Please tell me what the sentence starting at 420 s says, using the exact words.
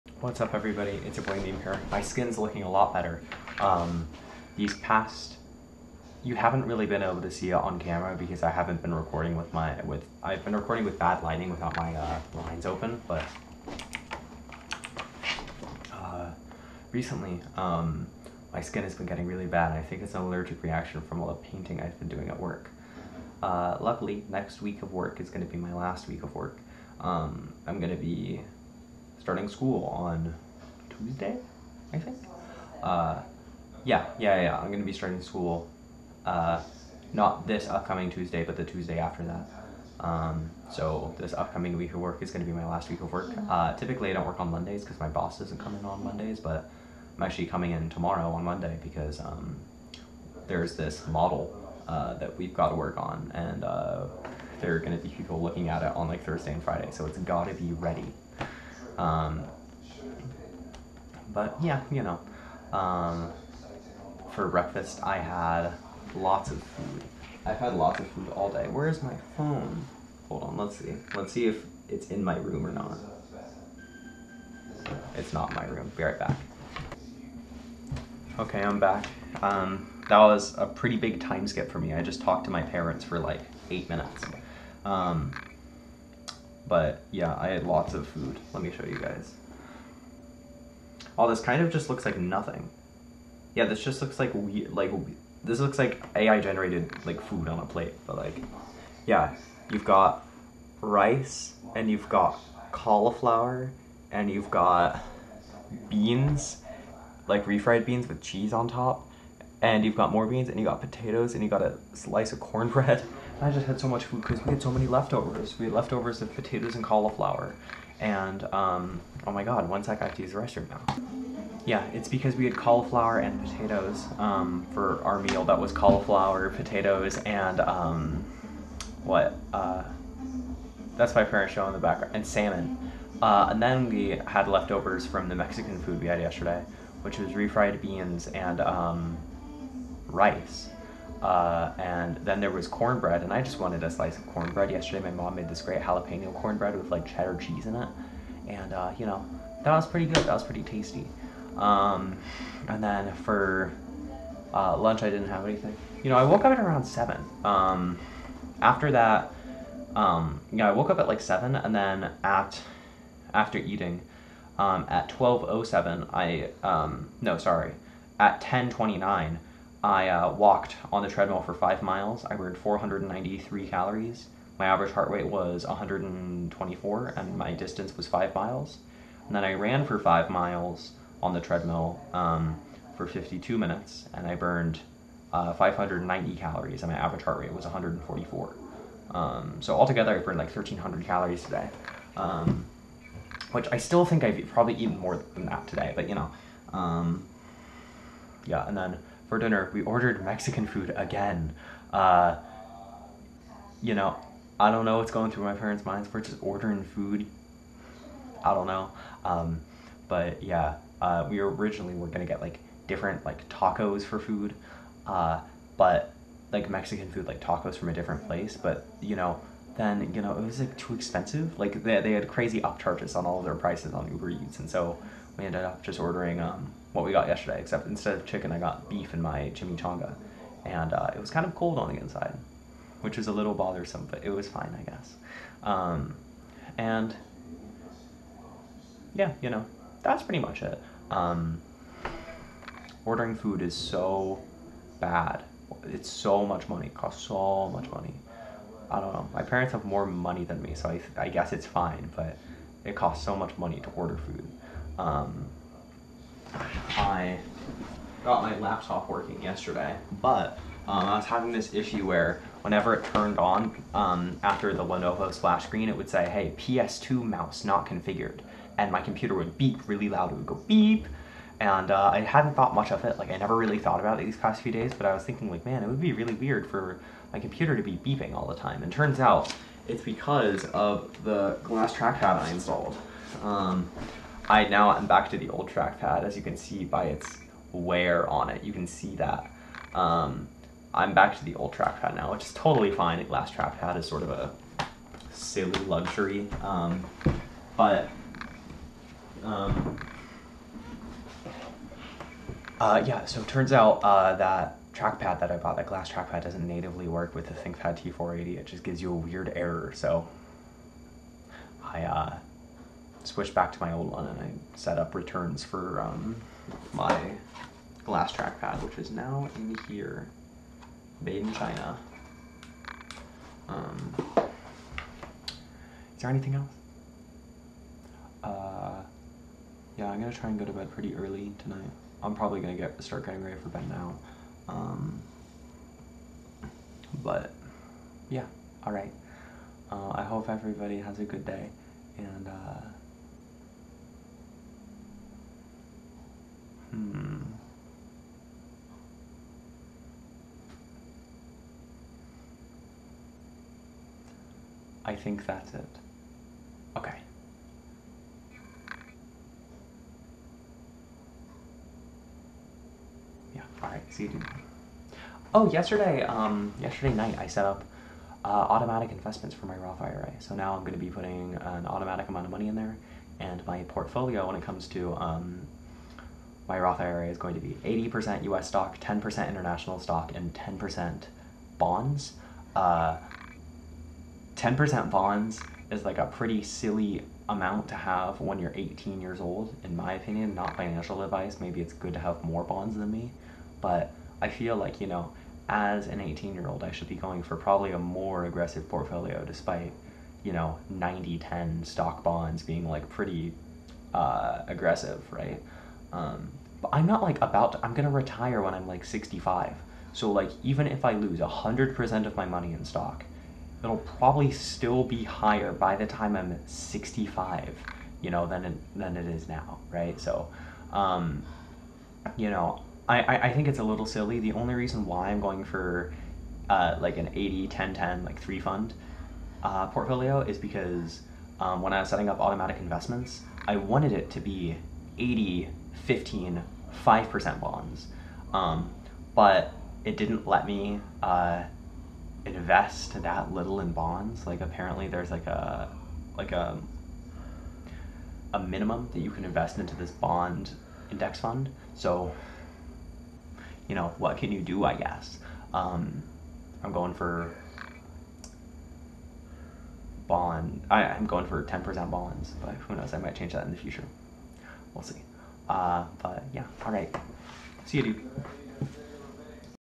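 So, um, you know, I, I think it's a little silly.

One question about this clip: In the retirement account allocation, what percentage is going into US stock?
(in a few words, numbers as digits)
80%.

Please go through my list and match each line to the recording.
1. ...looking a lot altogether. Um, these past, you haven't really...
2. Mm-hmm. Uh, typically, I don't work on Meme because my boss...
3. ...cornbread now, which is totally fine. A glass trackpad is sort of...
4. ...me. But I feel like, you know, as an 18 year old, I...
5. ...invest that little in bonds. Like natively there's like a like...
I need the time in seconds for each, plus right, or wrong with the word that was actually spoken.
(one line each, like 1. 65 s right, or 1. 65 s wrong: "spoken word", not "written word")
1. 2 s wrong: "better", not "altogether"
2. 43 s wrong: "Mondays", not "Meme"
3. 291 s wrong: "trackpad", not "cornbread"
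4. 393 s right
5. 442 s wrong: "apparently", not "natively".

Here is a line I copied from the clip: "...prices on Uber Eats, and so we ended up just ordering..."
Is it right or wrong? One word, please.
right.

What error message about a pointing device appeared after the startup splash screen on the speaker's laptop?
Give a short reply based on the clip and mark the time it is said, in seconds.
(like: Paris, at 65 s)
PS2 mouse not configured, at 266 s.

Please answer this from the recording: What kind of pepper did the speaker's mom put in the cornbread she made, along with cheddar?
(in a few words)
jalapeno.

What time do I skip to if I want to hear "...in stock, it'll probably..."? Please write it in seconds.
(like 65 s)
412 s.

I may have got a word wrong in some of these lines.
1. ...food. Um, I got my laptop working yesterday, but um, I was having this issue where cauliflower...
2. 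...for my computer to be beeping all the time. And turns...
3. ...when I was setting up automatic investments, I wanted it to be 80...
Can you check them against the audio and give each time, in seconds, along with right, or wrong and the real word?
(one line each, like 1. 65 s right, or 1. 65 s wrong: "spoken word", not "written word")
1. 254 s wrong: "whenever", not "cauliflower"
2. 276 s right
3. 431 s right.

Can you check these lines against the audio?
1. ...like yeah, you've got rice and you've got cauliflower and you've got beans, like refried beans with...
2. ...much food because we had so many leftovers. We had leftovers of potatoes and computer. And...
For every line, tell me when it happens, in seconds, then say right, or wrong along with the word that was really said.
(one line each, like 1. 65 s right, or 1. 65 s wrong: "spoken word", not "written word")
1. 98 s right
2. 113 s wrong: "cauliflower", not "computer".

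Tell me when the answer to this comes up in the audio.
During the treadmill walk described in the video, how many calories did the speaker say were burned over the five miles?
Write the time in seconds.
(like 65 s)
172 s.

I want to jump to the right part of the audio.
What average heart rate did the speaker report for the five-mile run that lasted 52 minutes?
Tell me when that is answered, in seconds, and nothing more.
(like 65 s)
187 s.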